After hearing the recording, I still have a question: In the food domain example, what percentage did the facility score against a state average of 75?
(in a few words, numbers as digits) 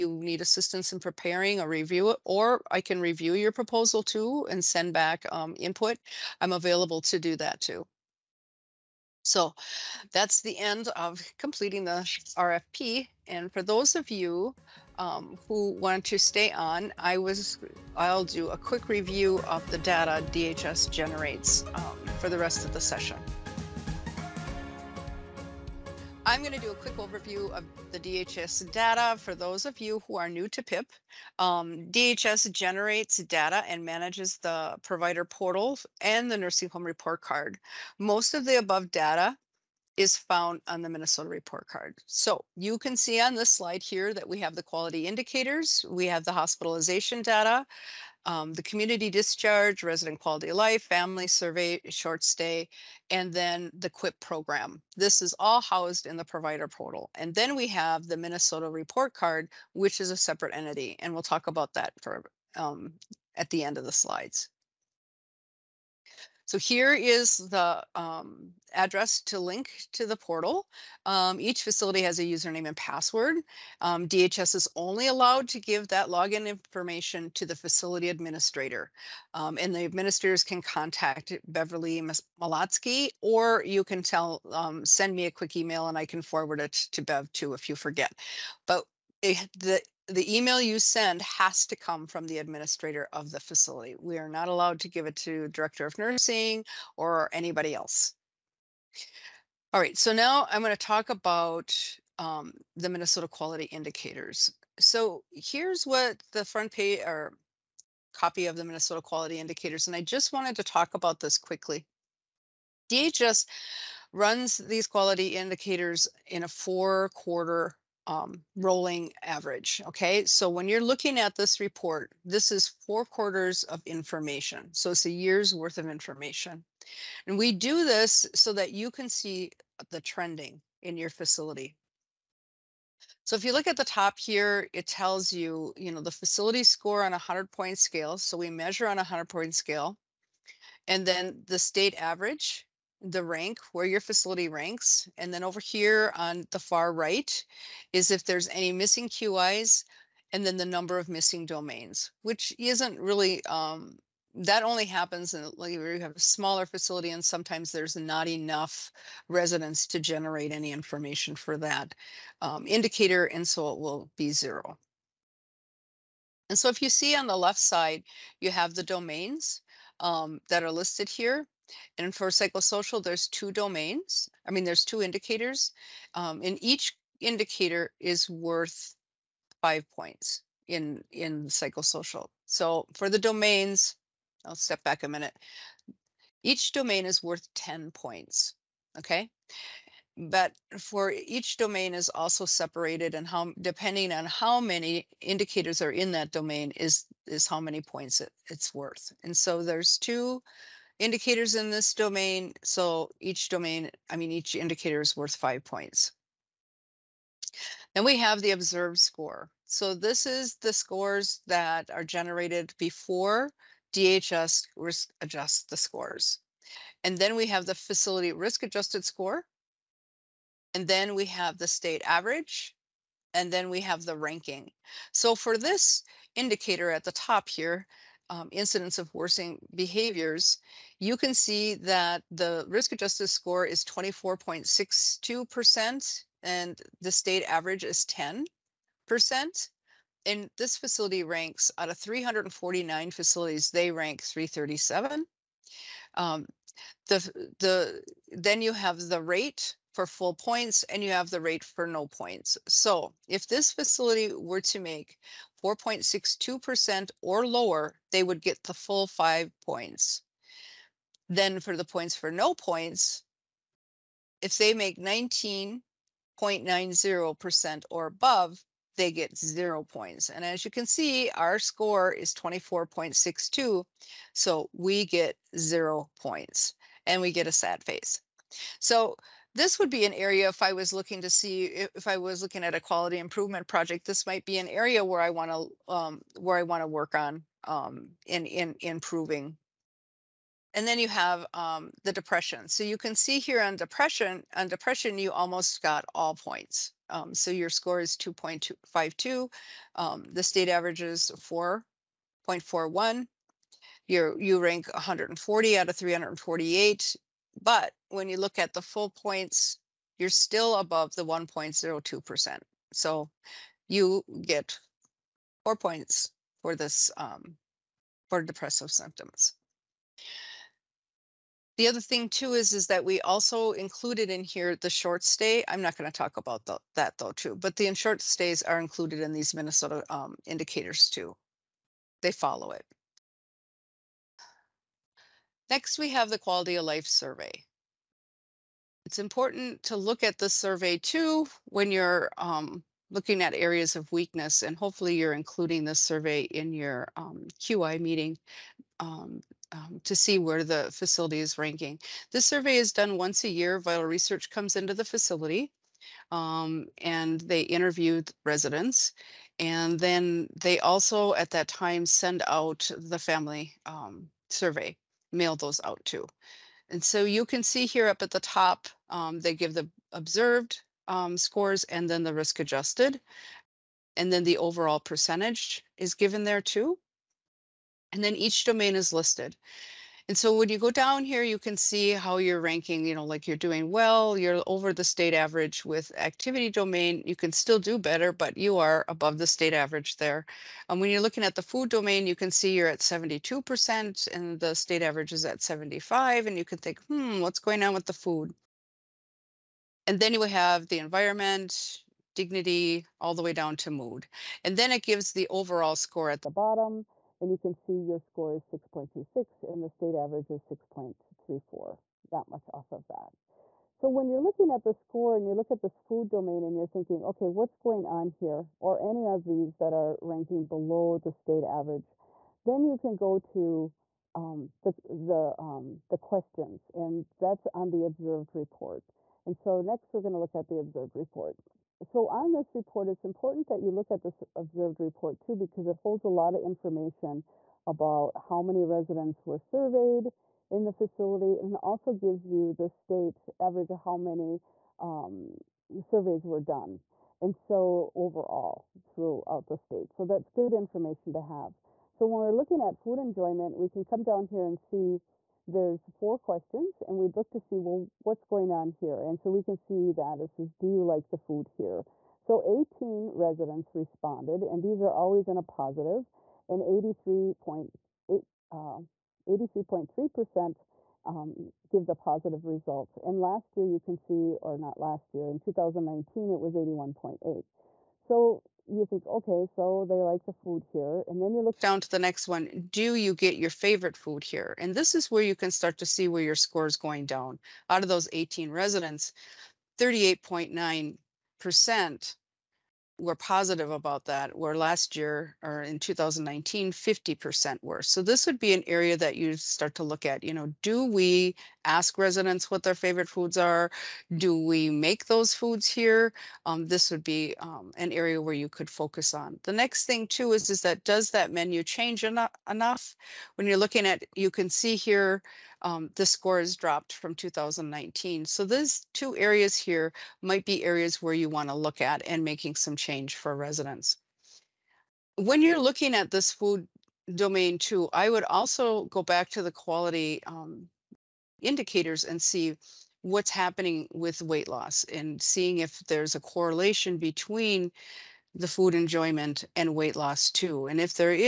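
72%.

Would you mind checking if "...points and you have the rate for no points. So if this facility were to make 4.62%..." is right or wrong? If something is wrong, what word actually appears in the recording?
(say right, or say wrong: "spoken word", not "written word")
right.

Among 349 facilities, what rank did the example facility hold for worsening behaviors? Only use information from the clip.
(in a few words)
337.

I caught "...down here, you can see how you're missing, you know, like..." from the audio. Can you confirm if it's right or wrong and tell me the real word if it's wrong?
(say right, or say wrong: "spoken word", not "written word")
wrong: "ranking", not "missing".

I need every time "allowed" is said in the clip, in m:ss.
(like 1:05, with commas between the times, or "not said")
1:15, 1:34.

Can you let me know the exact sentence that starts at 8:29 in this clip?
The next thing too is, is that does that menu change en enough?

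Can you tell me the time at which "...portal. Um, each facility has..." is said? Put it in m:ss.
1:10.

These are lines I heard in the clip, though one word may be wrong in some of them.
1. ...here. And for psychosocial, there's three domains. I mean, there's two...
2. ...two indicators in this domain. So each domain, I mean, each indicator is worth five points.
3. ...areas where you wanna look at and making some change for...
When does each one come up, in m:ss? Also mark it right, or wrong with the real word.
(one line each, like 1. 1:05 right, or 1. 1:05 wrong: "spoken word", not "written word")
1. 2:51 wrong: "two", not "three"
2. 3:19 right
3. 8:40 right.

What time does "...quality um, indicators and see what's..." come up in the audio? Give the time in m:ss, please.
8:49.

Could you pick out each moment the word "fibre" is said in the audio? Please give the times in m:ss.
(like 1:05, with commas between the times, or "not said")
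not said.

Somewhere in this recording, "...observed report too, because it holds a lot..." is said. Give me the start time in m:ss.
7:14.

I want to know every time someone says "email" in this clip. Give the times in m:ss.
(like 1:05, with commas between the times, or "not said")
1:25, 1:30.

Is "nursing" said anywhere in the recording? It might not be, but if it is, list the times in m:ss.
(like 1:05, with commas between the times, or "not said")
0:36, 1:35.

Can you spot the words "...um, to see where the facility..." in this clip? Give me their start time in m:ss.
5:49.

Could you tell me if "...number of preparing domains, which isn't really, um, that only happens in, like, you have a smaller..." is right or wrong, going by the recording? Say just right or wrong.
wrong.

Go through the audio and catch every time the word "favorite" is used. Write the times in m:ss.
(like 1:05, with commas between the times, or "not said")
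8:03, 8:22.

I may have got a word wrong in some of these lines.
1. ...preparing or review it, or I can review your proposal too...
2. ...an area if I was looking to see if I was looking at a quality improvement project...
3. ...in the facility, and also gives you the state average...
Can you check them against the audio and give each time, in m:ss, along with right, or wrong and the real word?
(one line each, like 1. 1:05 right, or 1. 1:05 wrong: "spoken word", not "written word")
1. 0:00 right
2. 4:40 right
3. 7:20 right.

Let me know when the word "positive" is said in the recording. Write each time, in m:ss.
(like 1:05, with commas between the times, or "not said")
7:45, 7:52, 8:13.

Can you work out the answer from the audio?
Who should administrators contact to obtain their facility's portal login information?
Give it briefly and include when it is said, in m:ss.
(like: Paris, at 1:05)
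Beverly Malatsky, at 1:21.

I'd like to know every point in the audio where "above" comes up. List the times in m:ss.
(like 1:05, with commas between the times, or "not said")
0:38, 4:28, 5:10, 6:29.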